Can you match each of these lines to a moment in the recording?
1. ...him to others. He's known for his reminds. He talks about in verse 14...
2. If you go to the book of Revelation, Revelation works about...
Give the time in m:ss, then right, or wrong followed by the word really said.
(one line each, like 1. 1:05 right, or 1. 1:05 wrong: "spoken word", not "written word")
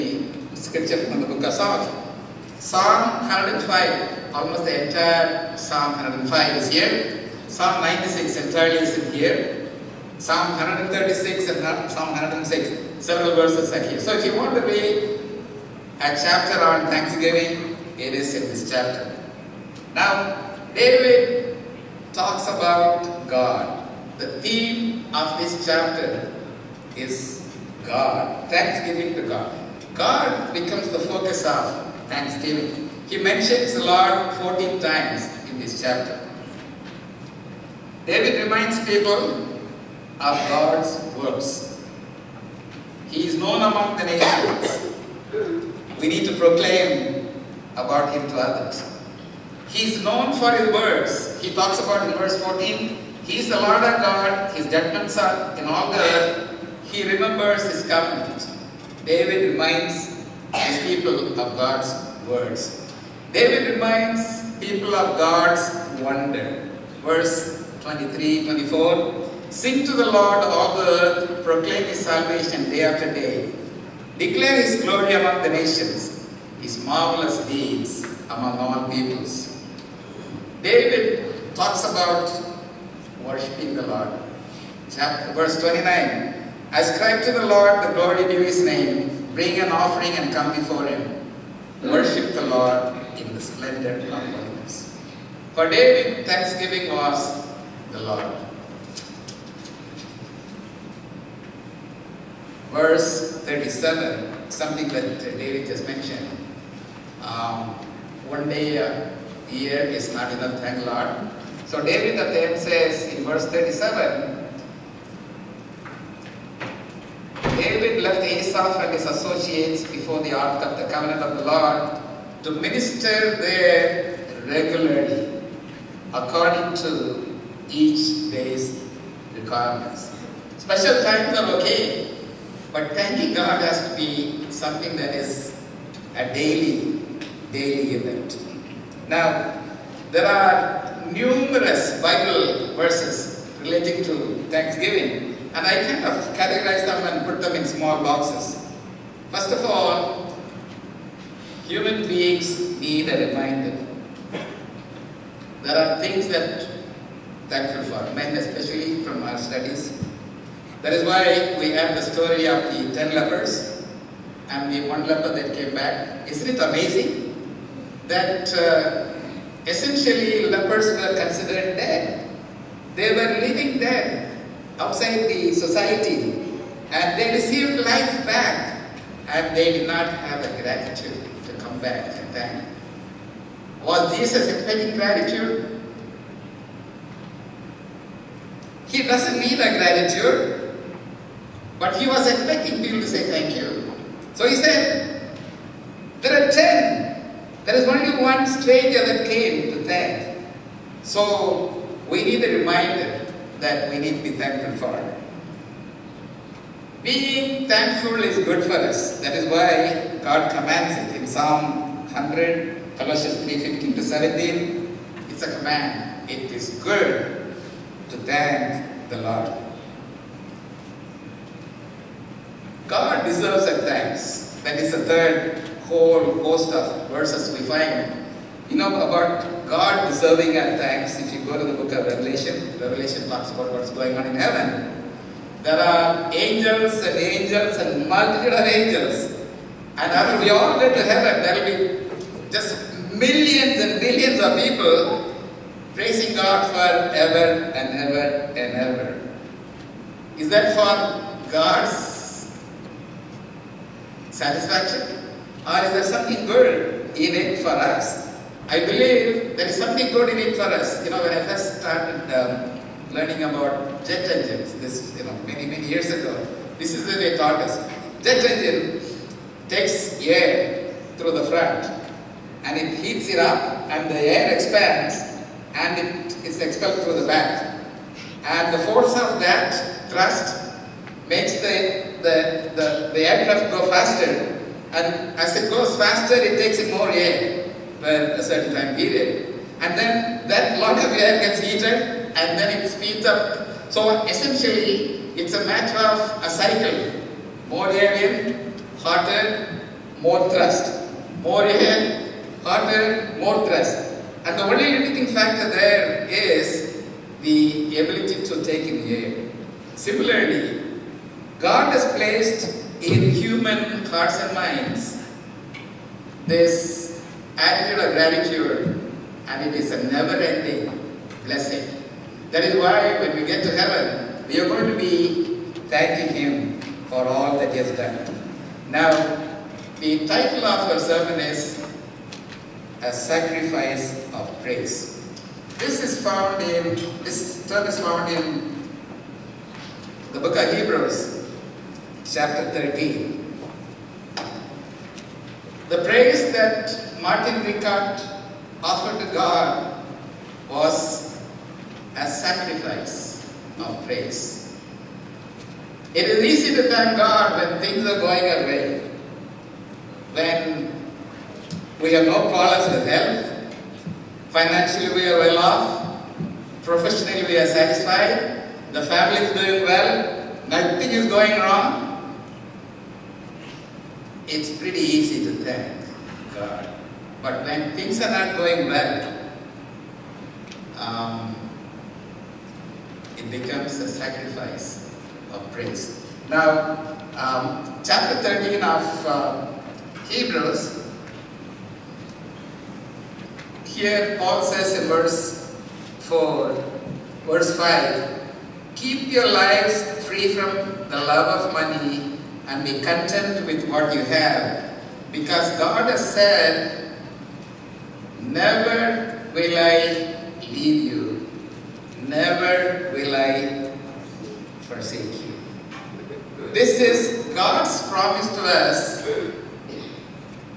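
1. 0:48 wrong: "words", not "reminds"
2. 3:51 wrong: "talks", not "works".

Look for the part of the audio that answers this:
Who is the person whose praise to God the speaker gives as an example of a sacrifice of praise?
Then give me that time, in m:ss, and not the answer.
5:47.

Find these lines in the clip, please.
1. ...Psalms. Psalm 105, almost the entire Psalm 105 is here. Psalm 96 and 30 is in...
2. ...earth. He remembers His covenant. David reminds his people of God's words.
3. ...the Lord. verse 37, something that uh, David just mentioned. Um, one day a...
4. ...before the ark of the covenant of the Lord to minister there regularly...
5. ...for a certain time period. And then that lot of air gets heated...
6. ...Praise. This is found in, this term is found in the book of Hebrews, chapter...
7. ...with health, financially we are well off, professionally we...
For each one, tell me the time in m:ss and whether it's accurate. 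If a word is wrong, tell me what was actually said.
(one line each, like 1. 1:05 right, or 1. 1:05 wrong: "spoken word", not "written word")
1. 0:01 right
2. 0:55 right
3. 1:37 right
4. 1:59 right
5. 4:47 right
6. 5:34 right
7. 6:02 right.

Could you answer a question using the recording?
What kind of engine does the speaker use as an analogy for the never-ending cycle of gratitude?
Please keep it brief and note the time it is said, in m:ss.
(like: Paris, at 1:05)
Jet engine, at 4:24.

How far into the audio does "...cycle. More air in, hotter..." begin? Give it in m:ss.
4:56.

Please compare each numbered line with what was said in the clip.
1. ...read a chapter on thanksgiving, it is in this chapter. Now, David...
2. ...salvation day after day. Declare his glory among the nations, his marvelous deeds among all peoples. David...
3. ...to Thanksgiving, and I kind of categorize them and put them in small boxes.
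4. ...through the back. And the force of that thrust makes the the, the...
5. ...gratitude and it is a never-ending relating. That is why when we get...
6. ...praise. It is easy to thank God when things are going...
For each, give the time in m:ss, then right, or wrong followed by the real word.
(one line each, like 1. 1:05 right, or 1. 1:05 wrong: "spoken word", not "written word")
1. 0:14 right
2. 1:12 right
3. 2:24 right
4. 4:37 right
5. 5:18 wrong: "blessing", not "relating"
6. 5:54 right.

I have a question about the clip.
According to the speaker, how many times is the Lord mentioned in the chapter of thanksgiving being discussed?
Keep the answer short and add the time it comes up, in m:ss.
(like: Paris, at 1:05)
14, at 0:34.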